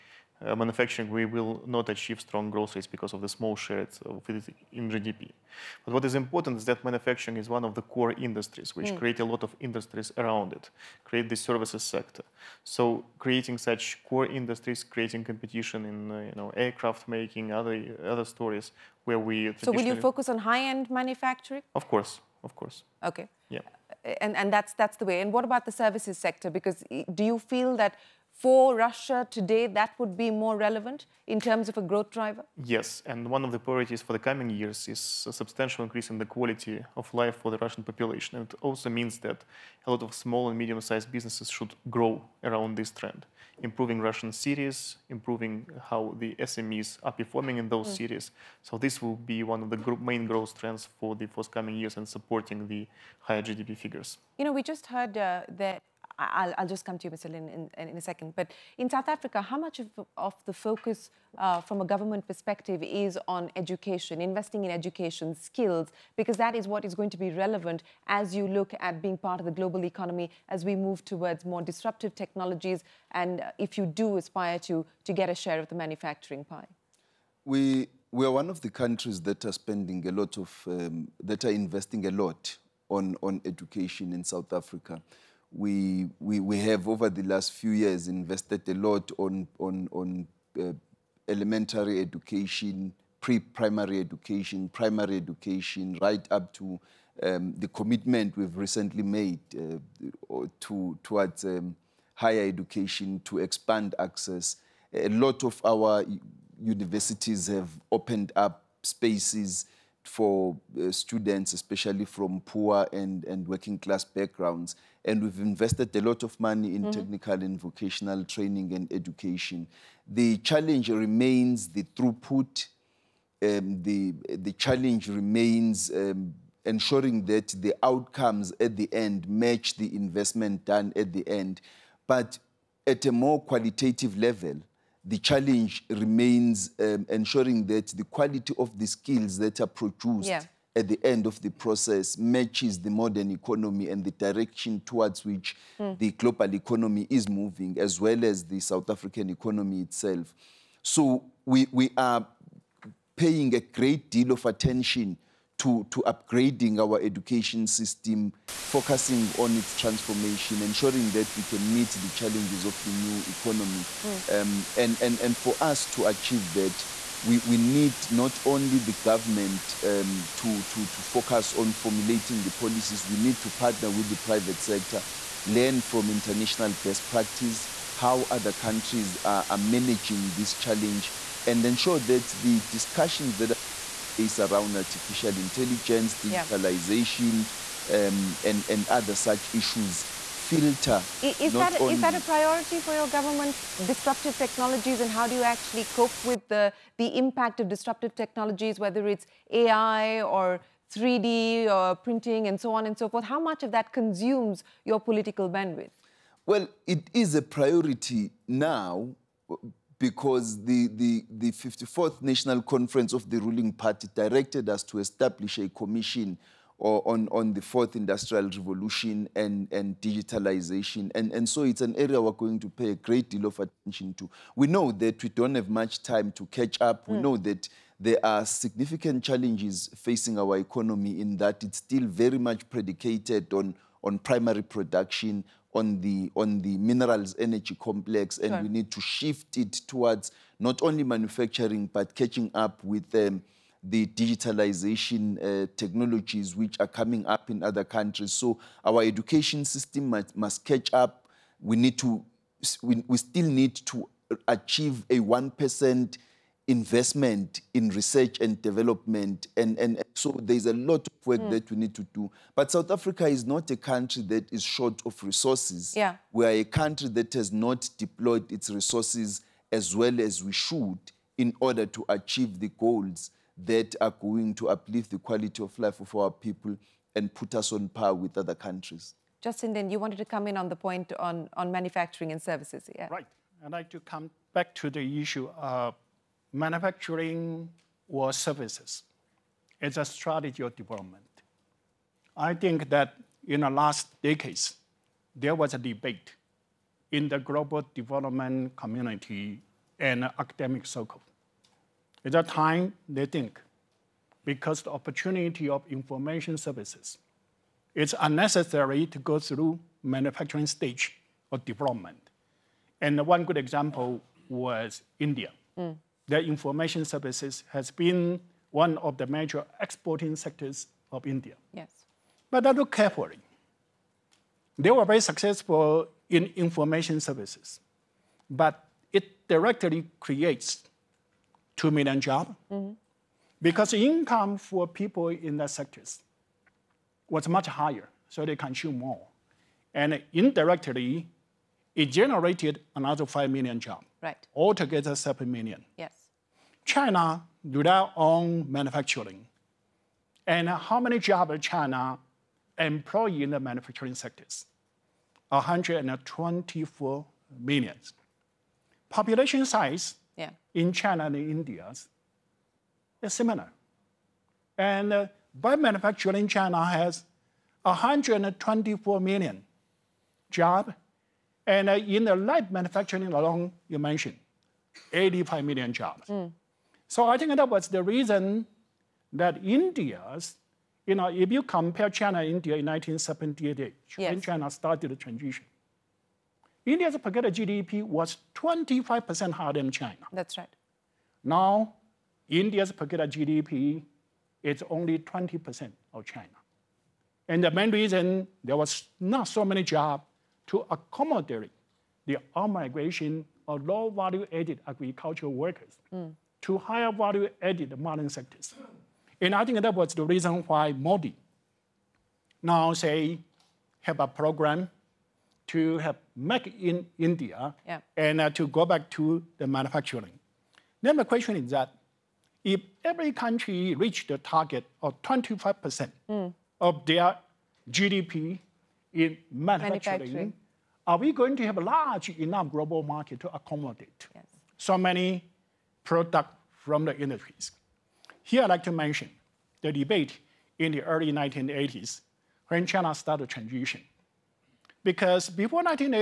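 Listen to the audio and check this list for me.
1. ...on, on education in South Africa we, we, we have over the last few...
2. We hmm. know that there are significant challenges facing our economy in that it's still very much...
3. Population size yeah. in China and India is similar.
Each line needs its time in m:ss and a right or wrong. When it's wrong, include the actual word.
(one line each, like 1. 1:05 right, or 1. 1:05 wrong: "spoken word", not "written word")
1. 1:22 right
2. 3:47 right
3. 5:59 right.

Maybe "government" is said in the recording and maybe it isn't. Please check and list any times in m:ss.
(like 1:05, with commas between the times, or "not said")
1:01, 2:48, 3:13.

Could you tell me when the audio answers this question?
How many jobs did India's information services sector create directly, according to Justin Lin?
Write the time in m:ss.
5:31.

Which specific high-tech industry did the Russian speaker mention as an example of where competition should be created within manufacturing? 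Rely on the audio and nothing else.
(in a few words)
Aircraft making.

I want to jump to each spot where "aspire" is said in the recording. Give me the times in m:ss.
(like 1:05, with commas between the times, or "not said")
1:14.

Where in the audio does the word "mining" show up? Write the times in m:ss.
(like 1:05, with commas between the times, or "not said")
6:47.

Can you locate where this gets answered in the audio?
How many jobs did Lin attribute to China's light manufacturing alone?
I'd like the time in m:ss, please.
6:15.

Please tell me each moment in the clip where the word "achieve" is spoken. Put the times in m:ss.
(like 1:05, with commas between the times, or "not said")
0:01, 2:46, 4:14, 4:32.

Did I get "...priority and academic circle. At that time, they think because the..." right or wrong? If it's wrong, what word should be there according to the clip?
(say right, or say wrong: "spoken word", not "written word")
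wrong: "community", not "priority".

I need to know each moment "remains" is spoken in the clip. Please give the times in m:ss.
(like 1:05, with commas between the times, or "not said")
2:00, 2:05, 2:15.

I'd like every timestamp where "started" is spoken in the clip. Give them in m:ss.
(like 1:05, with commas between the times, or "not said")
6:24, 7:23.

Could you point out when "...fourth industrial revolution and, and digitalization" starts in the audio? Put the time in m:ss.
3:37.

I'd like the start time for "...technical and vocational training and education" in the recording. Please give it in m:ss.
1:56.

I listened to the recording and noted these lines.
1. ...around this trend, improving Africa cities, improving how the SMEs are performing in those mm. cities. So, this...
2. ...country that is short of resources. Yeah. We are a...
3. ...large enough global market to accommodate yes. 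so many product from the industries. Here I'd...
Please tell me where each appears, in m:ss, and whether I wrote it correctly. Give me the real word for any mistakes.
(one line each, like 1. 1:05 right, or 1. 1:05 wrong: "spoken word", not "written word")
1. 0:42 wrong: "Russian", not "Africa"
2. 4:23 right
3. 7:11 right.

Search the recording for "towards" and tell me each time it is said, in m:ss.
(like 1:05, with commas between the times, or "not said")
1:11, 1:41, 2:24, 3:59.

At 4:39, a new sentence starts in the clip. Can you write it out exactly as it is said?
Justin, then you wanted to come in on the point on, on manufacturing and services.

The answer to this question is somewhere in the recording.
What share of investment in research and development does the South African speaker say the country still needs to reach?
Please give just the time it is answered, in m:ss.
4:15.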